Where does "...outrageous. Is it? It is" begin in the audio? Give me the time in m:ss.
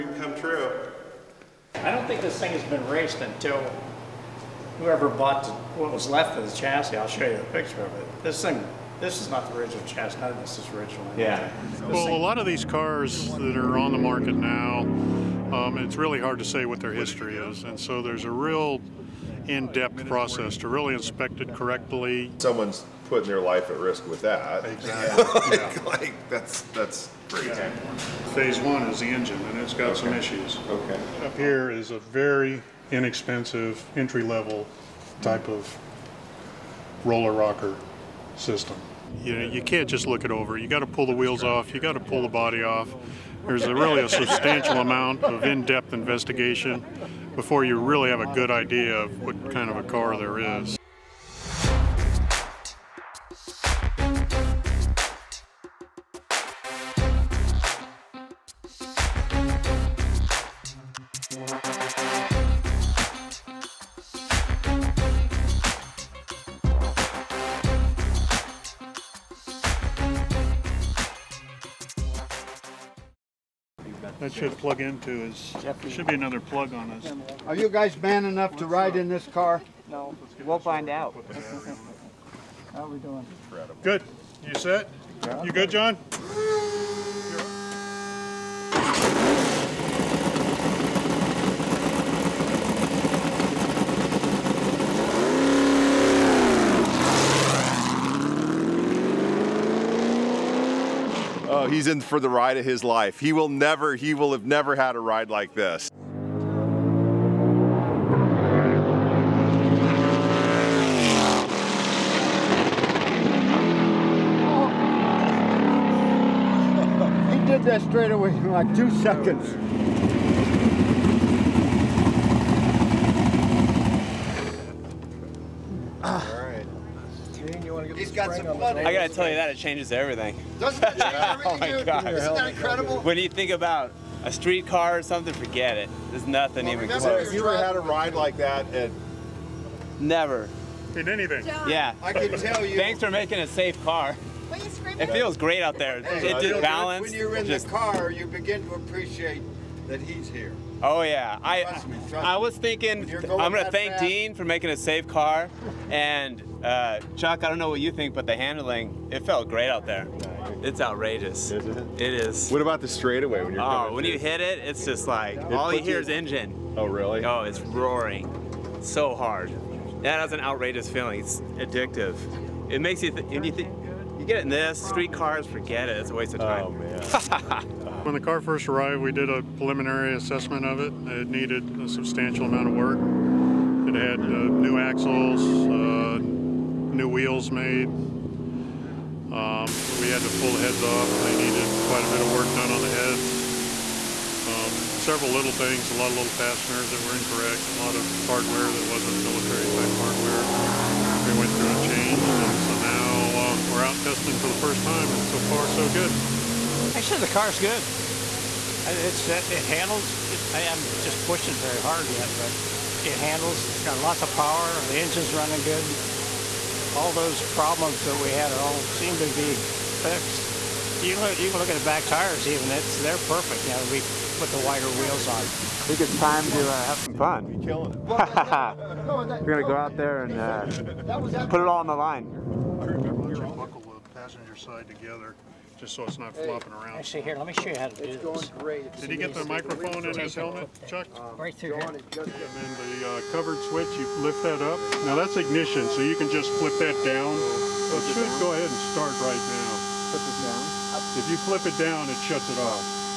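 2:40.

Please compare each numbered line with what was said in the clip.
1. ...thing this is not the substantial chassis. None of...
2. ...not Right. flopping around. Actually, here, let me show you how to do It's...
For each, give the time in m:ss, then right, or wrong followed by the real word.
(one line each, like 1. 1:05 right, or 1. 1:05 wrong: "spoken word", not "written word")
1. 0:08 wrong: "original", not "substantial"
2. 3:56 wrong: "Hey", not "Right".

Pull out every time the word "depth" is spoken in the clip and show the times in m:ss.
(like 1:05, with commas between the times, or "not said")
0:19, 0:45.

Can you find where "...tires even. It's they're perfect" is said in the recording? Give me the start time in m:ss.
3:42.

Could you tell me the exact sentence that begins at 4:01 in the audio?
And then the uh, covered switch, you lift that up.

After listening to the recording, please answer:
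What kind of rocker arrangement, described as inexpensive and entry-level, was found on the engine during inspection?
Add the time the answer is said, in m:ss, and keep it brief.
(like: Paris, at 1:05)
roller rocker system, at 0:37.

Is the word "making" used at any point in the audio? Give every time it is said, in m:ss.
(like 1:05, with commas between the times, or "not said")
2:23, 2:34.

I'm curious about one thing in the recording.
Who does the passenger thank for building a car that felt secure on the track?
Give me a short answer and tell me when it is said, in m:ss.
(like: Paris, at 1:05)
Dean, at 2:34.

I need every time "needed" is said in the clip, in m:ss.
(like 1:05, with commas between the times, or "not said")
3:01, 3:11.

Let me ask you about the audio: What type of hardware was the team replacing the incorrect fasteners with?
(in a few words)
military type hardware.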